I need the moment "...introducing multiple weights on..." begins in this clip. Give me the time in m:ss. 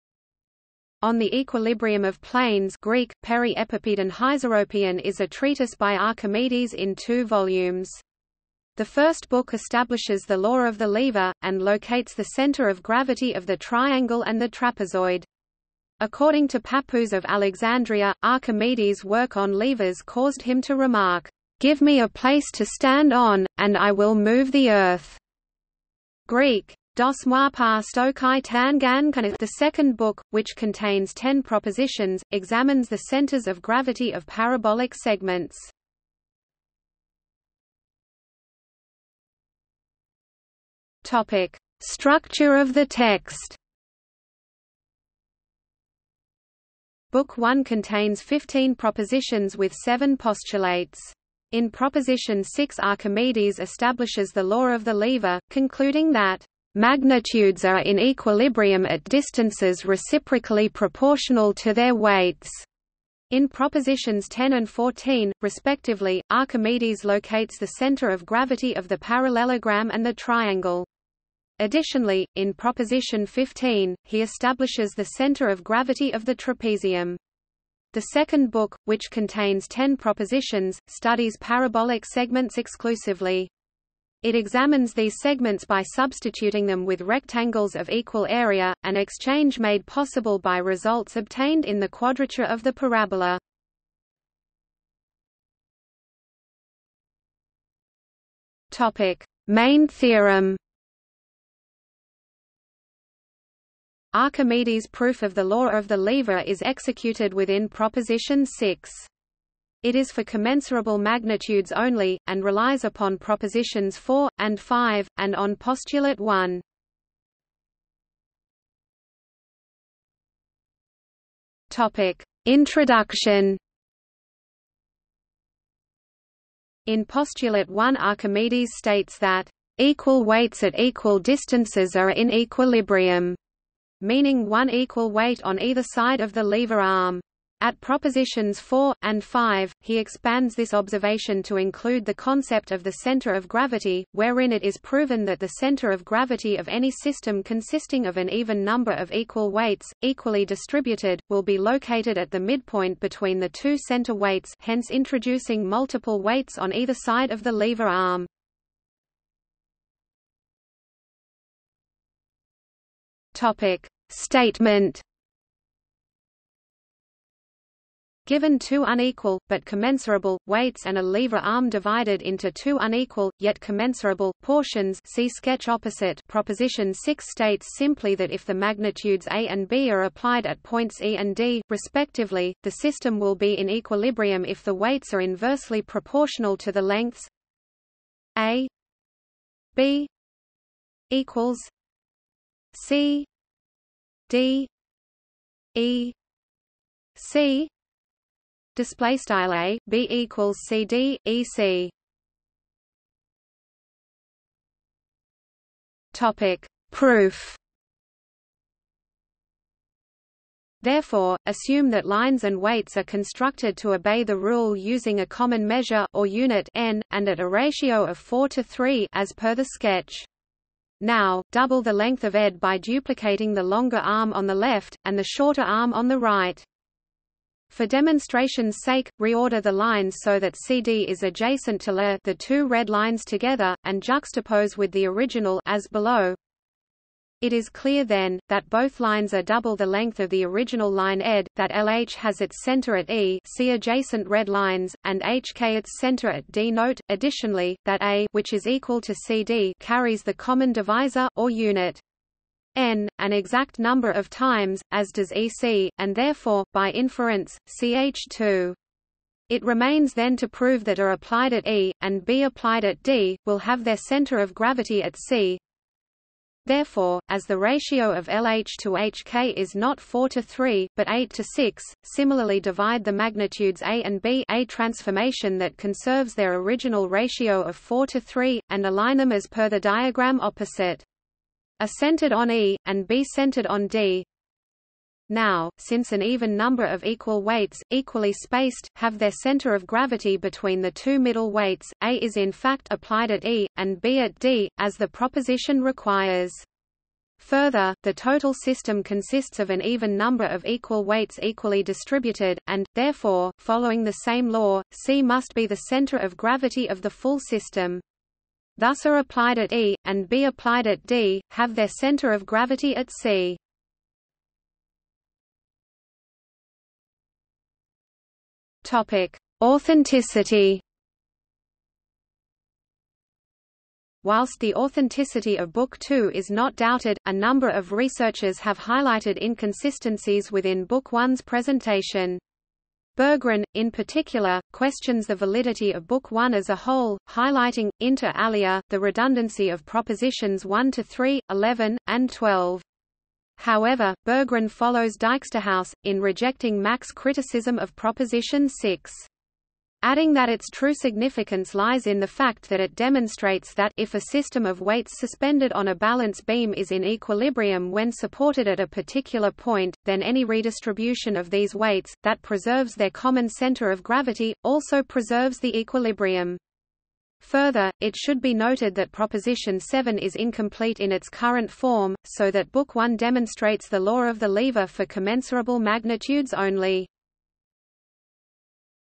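2:34.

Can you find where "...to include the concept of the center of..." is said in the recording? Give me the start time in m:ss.
2:21.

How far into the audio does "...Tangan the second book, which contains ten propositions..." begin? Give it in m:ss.
0:28.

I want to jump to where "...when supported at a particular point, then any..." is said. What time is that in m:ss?
5:57.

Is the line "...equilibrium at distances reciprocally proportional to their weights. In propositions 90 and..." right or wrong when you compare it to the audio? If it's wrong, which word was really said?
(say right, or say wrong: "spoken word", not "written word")
wrong: "10", not "90".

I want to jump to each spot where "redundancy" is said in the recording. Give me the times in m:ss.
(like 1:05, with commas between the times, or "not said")
5:38.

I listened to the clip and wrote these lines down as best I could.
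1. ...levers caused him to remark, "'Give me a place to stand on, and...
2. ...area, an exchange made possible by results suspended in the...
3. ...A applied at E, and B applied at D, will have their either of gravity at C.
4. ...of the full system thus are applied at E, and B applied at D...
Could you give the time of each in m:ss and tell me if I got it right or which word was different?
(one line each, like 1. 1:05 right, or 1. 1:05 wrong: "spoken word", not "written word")
1. 0:19 right
2. 1:28 wrong: "obtained", not "suspended"
3. 4:20 wrong: "center", not "either"
4. 5:06 right.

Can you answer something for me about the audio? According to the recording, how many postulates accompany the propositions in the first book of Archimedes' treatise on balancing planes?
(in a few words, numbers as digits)
7.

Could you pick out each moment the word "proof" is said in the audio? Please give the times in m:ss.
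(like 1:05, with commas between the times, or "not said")
1:44, 3:26.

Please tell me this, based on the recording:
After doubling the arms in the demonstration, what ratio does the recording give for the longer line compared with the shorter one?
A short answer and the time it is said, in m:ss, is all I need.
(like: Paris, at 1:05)
8 to 6, at 4:31.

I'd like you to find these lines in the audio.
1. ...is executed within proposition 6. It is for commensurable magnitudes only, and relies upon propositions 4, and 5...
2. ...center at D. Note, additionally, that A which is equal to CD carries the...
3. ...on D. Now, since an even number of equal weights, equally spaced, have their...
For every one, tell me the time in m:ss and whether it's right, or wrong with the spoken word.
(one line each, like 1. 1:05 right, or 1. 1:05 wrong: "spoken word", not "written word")
1. 1:46 right
2. 4:05 right
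3. 4:43 right.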